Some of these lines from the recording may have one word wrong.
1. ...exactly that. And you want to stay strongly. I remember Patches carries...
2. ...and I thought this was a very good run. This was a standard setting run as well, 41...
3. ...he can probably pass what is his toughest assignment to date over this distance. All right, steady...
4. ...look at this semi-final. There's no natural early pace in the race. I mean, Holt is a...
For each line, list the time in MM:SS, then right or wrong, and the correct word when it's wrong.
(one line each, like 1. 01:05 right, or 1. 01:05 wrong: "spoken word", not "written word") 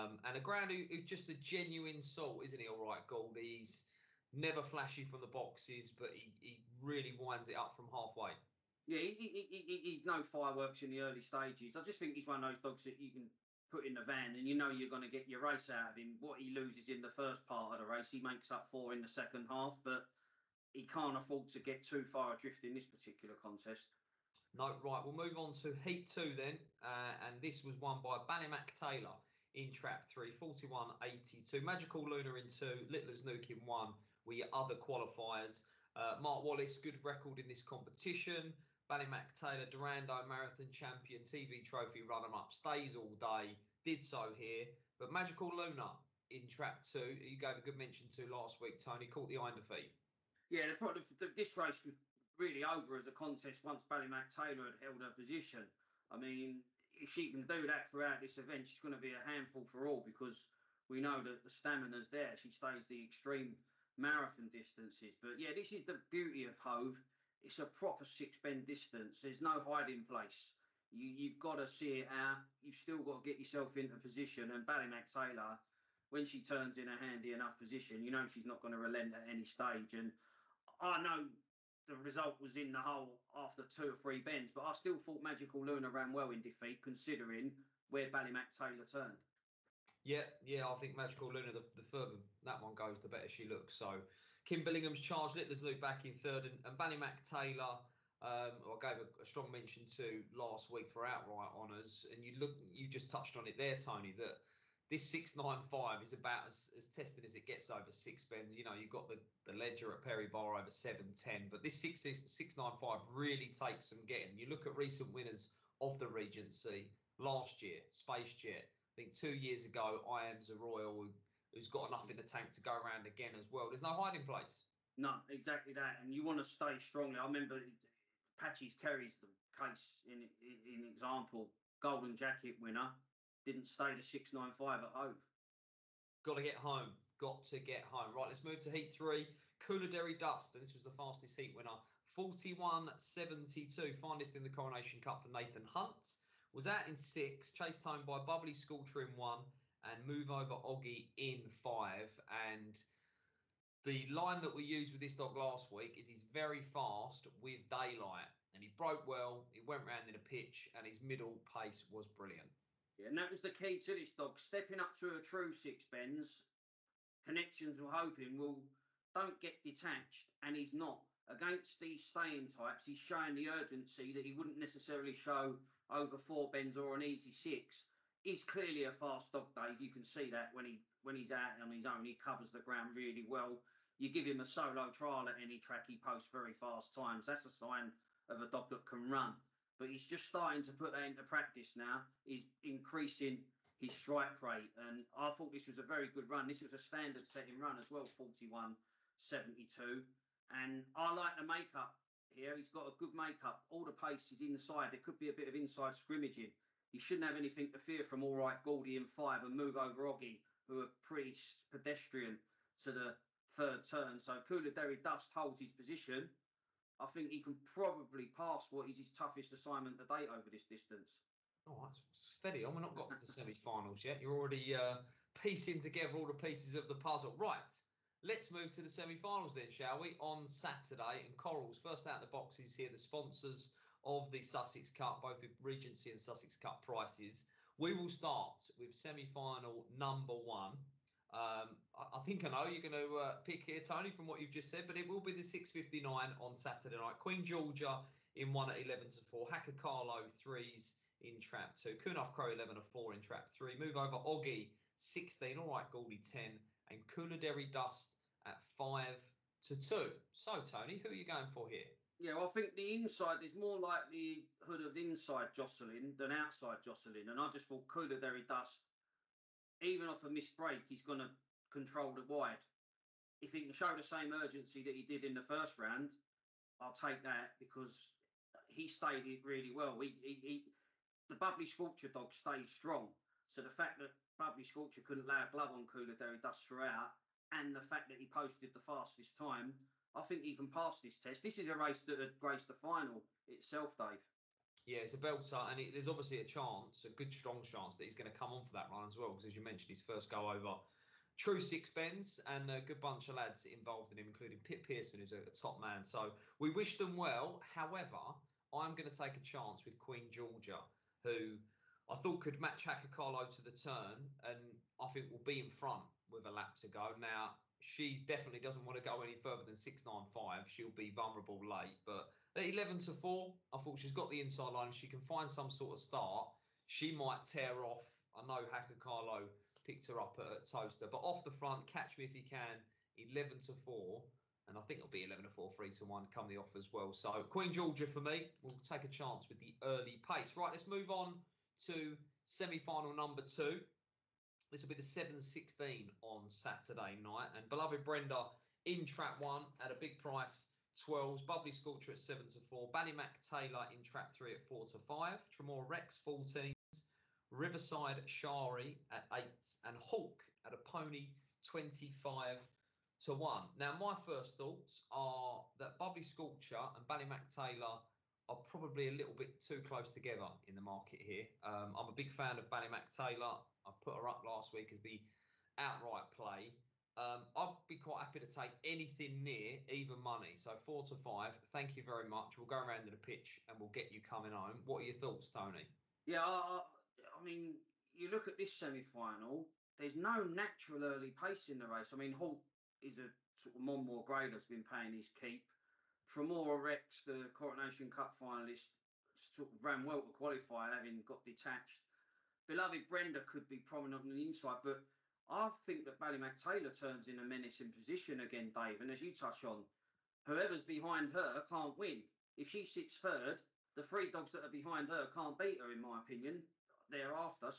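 1. 02:05 right
2. 03:14 right
3. 03:37 right
4. 06:28 right.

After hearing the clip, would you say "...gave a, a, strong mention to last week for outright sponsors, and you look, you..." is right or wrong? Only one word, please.
wrong.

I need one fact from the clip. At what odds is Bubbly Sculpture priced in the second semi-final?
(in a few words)
7 to 4.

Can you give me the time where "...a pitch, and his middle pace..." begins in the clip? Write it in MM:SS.
02:40.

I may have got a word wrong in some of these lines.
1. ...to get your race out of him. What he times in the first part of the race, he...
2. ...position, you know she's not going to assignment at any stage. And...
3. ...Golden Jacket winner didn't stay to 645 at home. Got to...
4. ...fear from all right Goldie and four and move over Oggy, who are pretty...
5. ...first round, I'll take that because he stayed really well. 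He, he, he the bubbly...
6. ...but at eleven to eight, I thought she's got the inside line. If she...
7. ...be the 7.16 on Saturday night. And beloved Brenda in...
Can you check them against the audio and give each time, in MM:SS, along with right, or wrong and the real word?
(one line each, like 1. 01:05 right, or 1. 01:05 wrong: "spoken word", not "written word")
1. 00:15 wrong: "loses", not "times"
2. 01:17 wrong: "relent", not "assignment"
3. 02:11 wrong: "695", not "645"
4. 03:27 wrong: "five", not "four"
5. 04:35 right
6. 05:22 wrong: "four", not "eight"
7. 05:44 right.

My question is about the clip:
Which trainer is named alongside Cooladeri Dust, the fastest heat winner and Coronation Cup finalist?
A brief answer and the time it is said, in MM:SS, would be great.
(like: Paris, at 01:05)
Nathan Hunt, at 02:25.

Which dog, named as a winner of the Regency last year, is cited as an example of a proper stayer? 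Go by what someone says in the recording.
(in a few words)
Spacejet.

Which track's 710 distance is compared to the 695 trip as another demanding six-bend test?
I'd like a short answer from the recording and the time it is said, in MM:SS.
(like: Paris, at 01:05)
Perry Barr, at 01:50.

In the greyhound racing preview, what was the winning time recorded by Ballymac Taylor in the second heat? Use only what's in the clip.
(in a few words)
41.82.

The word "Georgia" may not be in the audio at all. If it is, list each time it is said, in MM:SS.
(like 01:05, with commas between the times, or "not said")
04:07, 05:10, 05:37.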